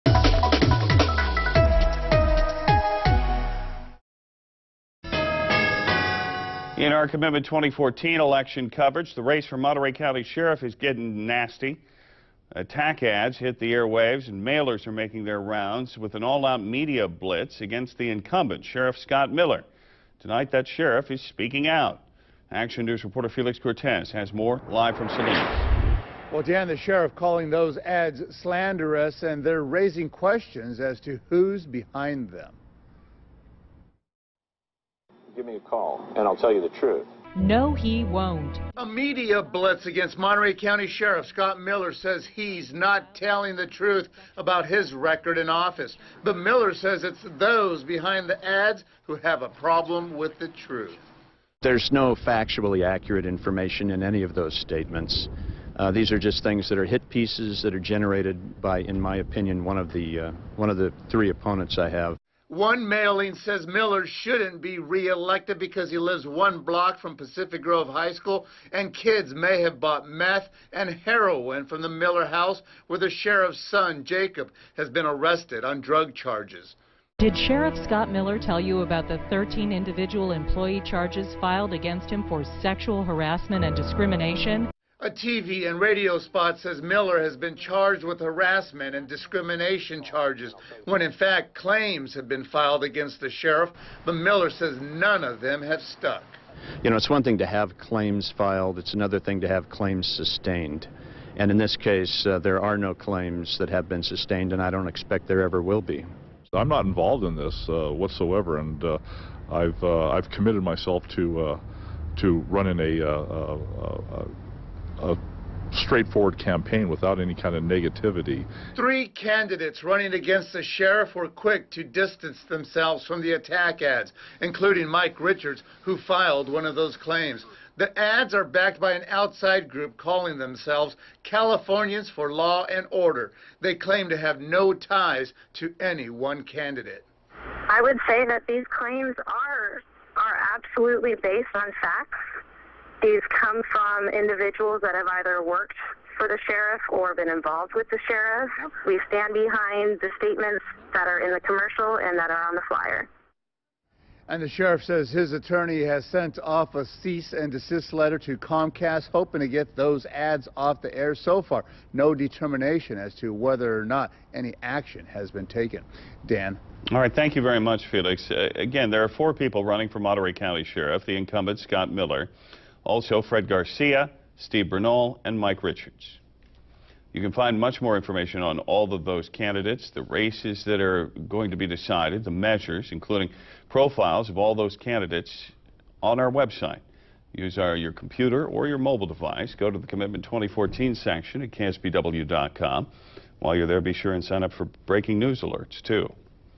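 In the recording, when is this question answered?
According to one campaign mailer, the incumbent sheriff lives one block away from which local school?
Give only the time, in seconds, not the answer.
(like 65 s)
67 s.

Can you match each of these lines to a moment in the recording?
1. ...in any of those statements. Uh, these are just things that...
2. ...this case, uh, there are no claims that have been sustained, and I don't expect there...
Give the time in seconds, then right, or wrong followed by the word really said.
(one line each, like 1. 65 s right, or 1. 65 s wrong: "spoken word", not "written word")
1. 53 s right
2. 101 s right.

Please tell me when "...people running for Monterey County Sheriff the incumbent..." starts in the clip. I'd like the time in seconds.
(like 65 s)
169 s.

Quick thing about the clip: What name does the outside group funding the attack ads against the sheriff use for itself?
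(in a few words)
Californians for Law and Order.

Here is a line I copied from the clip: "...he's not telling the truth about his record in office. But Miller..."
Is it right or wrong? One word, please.
right.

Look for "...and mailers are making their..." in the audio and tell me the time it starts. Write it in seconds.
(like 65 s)
14 s.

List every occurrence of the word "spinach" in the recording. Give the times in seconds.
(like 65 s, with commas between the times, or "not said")
not said.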